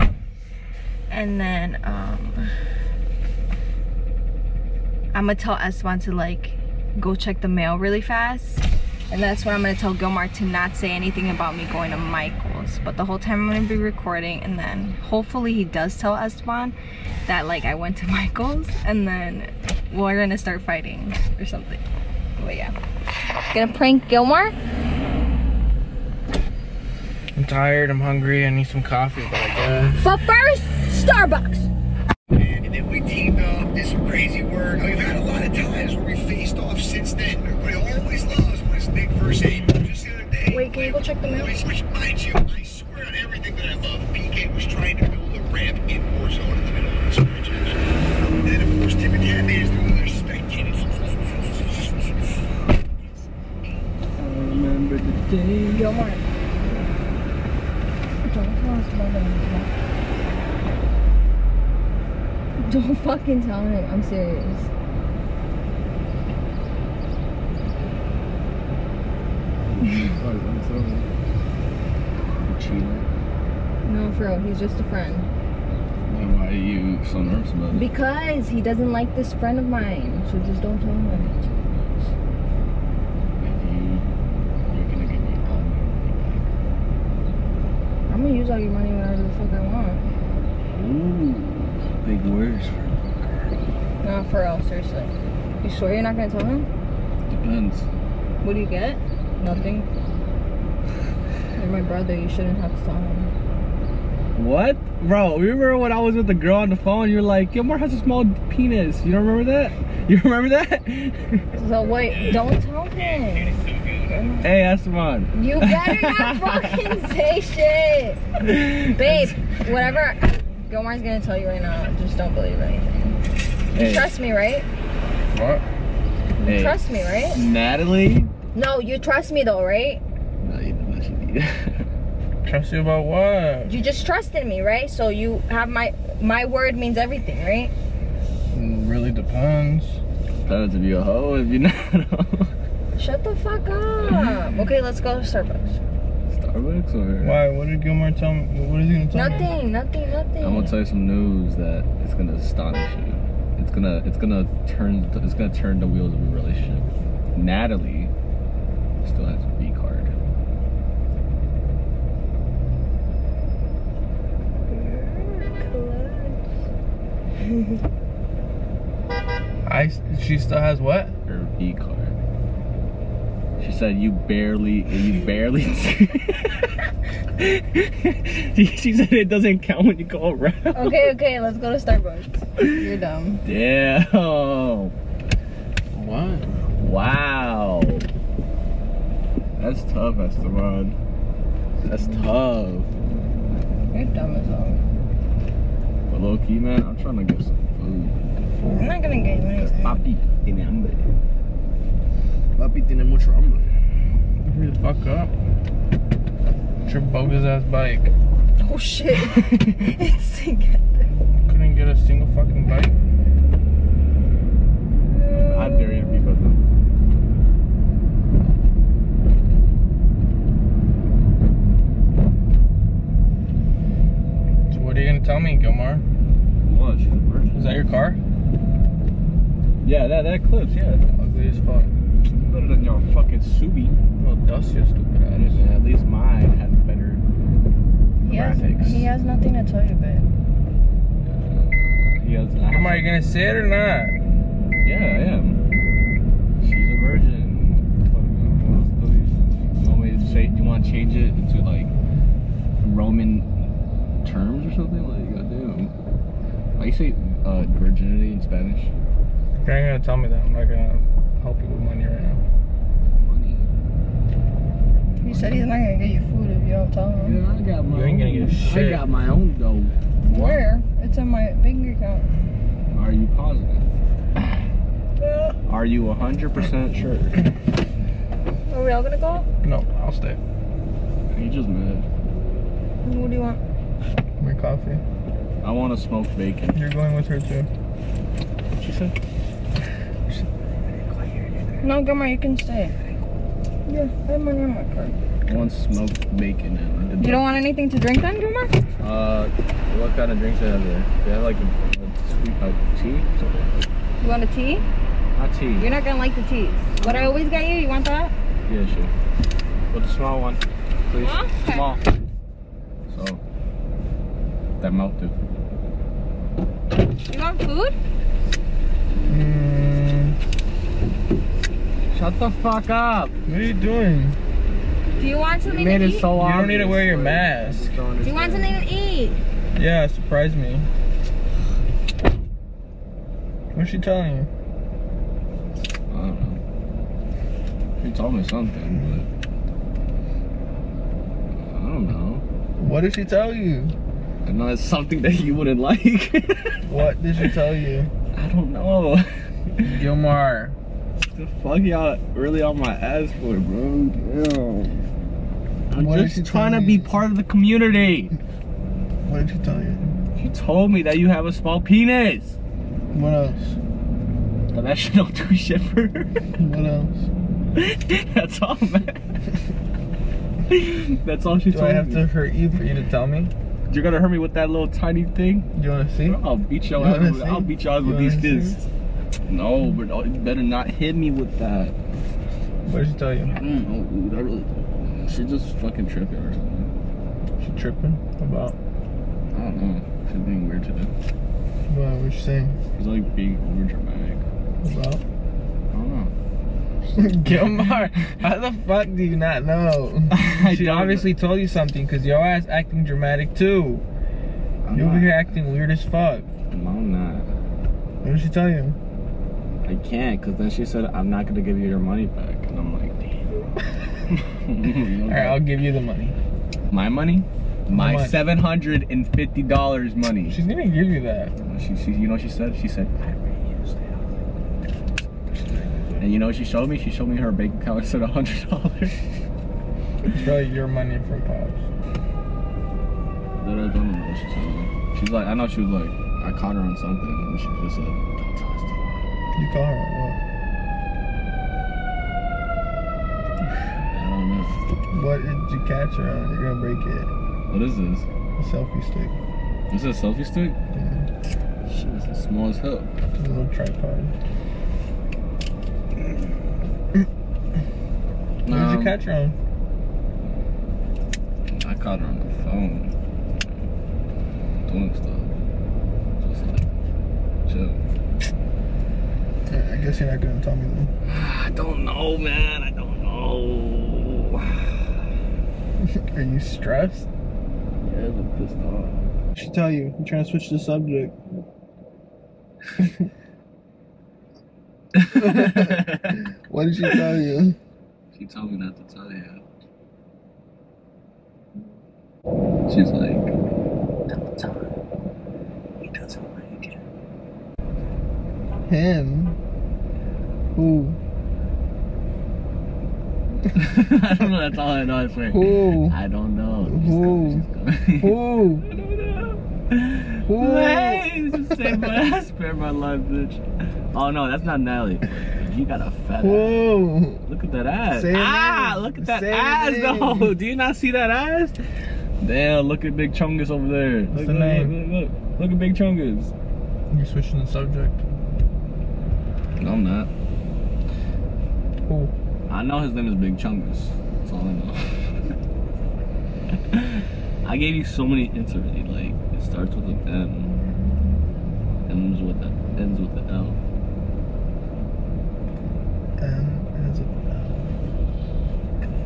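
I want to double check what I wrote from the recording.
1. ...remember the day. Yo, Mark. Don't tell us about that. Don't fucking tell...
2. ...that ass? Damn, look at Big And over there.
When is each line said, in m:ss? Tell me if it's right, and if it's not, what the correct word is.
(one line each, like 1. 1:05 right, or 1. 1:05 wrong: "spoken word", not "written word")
1. 0:54 right
2. 8:41 wrong: "Chungus", not "And".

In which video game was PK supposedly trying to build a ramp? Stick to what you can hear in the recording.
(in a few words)
Warzone.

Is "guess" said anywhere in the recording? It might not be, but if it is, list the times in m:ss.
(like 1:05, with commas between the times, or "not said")
0:29, 7:49.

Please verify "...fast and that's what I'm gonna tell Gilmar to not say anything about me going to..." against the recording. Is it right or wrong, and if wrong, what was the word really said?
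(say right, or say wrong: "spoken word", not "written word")
right.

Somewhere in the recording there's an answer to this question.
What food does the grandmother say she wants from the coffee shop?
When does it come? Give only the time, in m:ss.
4:55.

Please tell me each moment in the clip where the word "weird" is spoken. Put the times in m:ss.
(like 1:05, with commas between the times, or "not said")
6:30, 6:45.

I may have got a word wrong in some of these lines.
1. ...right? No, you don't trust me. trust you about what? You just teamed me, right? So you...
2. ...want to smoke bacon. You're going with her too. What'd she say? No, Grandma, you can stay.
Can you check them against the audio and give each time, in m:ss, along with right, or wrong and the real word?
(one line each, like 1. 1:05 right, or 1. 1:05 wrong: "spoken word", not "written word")
1. 2:09 wrong: "trusted", not "teamed"
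2. 4:45 right.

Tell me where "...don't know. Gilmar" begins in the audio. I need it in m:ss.
5:48.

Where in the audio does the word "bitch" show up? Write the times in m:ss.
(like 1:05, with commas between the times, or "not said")
8:33.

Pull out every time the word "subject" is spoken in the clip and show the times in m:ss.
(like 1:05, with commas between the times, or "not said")
8:00, 8:47.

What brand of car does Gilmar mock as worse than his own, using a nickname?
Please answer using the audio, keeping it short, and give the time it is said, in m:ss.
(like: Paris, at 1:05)
Subi, at 3:53.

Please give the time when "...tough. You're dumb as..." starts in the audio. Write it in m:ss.
3:12.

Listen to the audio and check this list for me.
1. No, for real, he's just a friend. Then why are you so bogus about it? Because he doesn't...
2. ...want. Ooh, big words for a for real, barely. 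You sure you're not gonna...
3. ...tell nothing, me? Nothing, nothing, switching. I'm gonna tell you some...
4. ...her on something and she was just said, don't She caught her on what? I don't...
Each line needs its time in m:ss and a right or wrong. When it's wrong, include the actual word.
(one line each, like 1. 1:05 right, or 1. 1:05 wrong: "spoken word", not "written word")
1. 1:13 wrong: "nervous", not "bogus"
2. 1:29 wrong: "seriously", not "barely"
3. 2:29 wrong: "nothing", not "switching"
4. 7:16 wrong: "You", not "She".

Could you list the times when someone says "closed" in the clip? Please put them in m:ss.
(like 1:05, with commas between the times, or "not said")
not said.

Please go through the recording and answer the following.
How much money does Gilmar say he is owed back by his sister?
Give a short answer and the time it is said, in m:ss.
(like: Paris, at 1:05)
$750, at 6:58.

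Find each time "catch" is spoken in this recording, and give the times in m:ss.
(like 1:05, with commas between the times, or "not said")
7:25, 7:39.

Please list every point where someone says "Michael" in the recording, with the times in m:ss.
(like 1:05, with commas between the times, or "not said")
0:11, 0:18.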